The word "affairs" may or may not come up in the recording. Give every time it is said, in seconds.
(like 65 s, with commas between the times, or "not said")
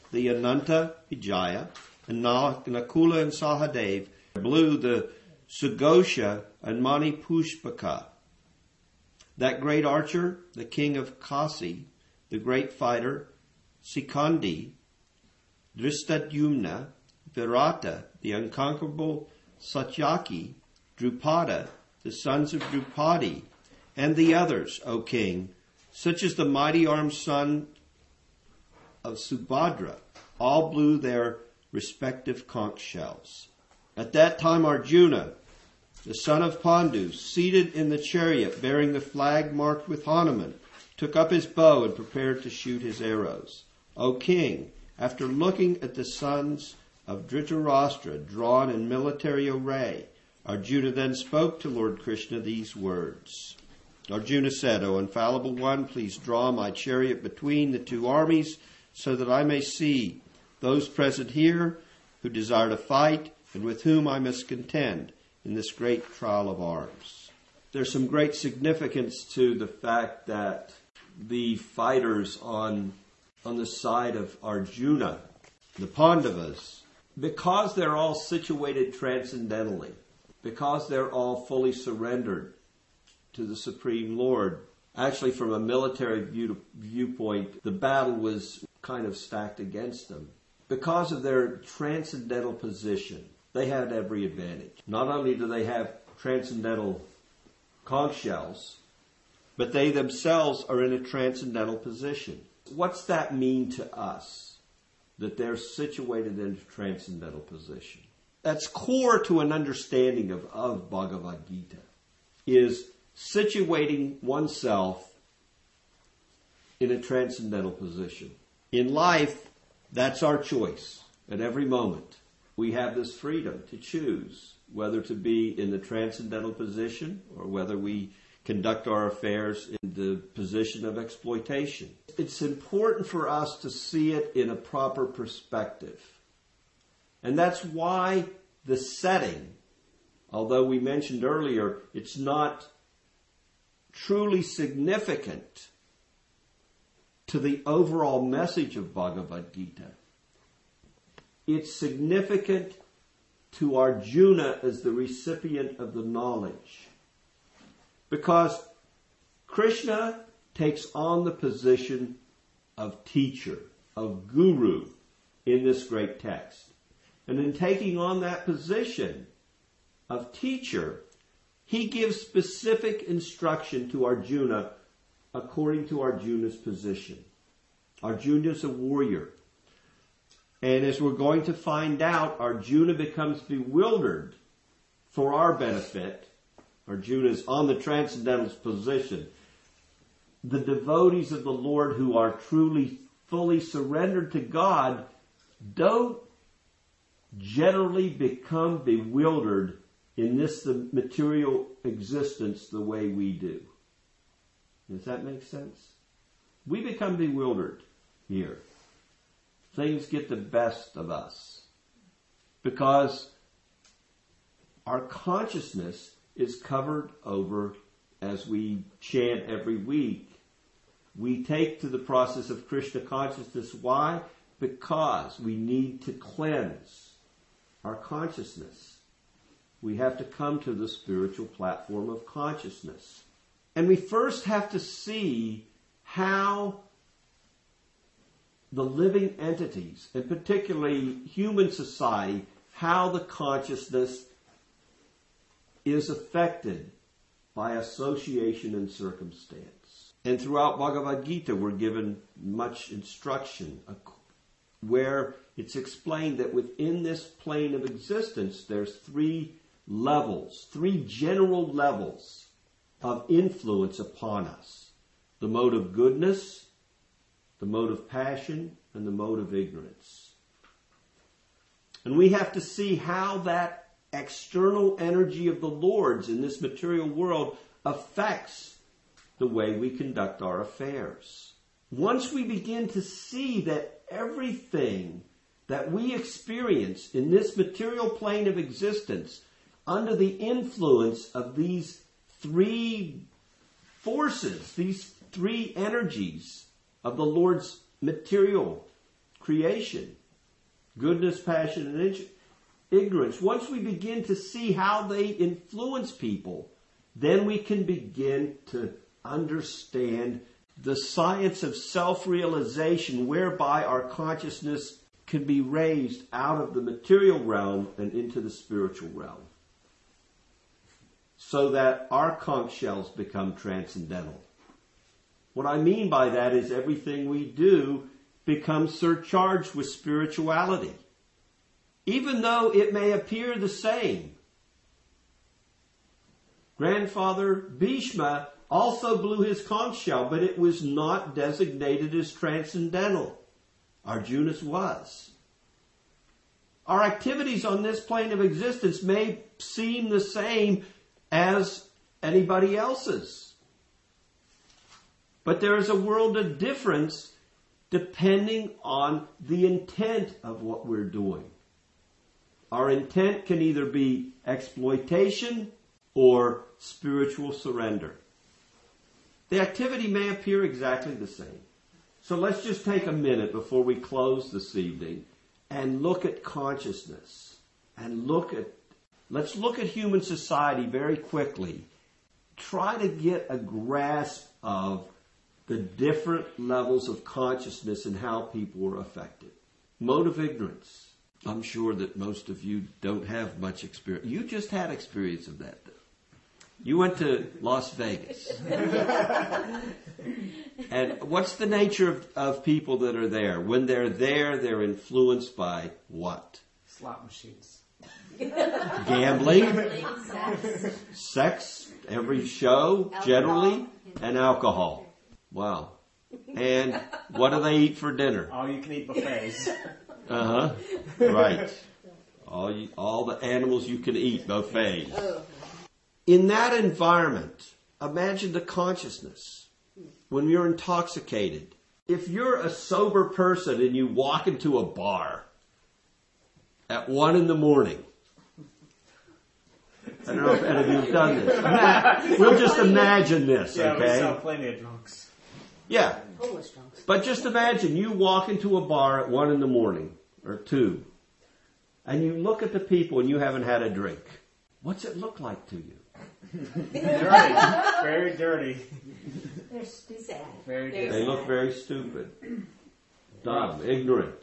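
129 s, 280 s.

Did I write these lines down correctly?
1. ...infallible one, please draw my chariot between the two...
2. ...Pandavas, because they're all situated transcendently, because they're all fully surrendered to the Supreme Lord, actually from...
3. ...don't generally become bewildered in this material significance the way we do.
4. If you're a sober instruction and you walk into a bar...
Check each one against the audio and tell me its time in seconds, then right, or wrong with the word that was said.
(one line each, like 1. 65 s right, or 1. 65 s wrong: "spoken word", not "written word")
1. 54 s right
2. 75 s right
3. 195 s wrong: "existence", not "significance"
4. 432 s wrong: "person", not "instruction".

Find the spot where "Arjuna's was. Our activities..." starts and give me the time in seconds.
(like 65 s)
344 s.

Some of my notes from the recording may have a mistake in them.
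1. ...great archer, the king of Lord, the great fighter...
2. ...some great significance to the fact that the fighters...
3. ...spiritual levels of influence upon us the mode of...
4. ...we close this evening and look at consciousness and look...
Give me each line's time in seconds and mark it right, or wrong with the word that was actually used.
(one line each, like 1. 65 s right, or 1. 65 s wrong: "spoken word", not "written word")
1. 9 s wrong: "Kasi", not "Lord"
2. 67 s right
3. 261 s wrong: "general", not "spiritual"
4. 373 s right.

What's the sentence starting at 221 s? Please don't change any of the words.
We take to the process of Krishna consciousness.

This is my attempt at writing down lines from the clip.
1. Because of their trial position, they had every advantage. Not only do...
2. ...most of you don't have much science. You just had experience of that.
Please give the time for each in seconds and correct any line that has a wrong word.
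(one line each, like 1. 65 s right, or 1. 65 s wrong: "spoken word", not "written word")
1. 90 s wrong: "transcendental", not "trial"
2. 392 s wrong: "experience", not "science".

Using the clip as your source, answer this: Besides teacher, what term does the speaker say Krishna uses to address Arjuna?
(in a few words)
guru.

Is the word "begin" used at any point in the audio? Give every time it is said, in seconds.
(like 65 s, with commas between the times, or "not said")
282 s, 303 s, 307 s.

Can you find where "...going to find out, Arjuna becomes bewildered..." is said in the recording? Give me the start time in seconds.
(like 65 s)
181 s.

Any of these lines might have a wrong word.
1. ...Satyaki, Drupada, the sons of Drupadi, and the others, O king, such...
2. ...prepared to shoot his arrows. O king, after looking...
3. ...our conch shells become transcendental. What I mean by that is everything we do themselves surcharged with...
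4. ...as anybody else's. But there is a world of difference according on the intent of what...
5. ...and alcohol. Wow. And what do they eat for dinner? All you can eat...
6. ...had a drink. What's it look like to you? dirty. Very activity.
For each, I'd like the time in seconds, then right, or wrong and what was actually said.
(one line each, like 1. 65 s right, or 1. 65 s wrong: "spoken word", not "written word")
1. 19 s right
2. 41 s right
3. 322 s wrong: "becomes", not "themselves"
4. 351 s wrong: "depending", not "according"
5. 414 s right
6. 453 s wrong: "dirty", not "activity".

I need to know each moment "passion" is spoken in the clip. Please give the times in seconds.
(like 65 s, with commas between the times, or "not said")
268 s, 301 s.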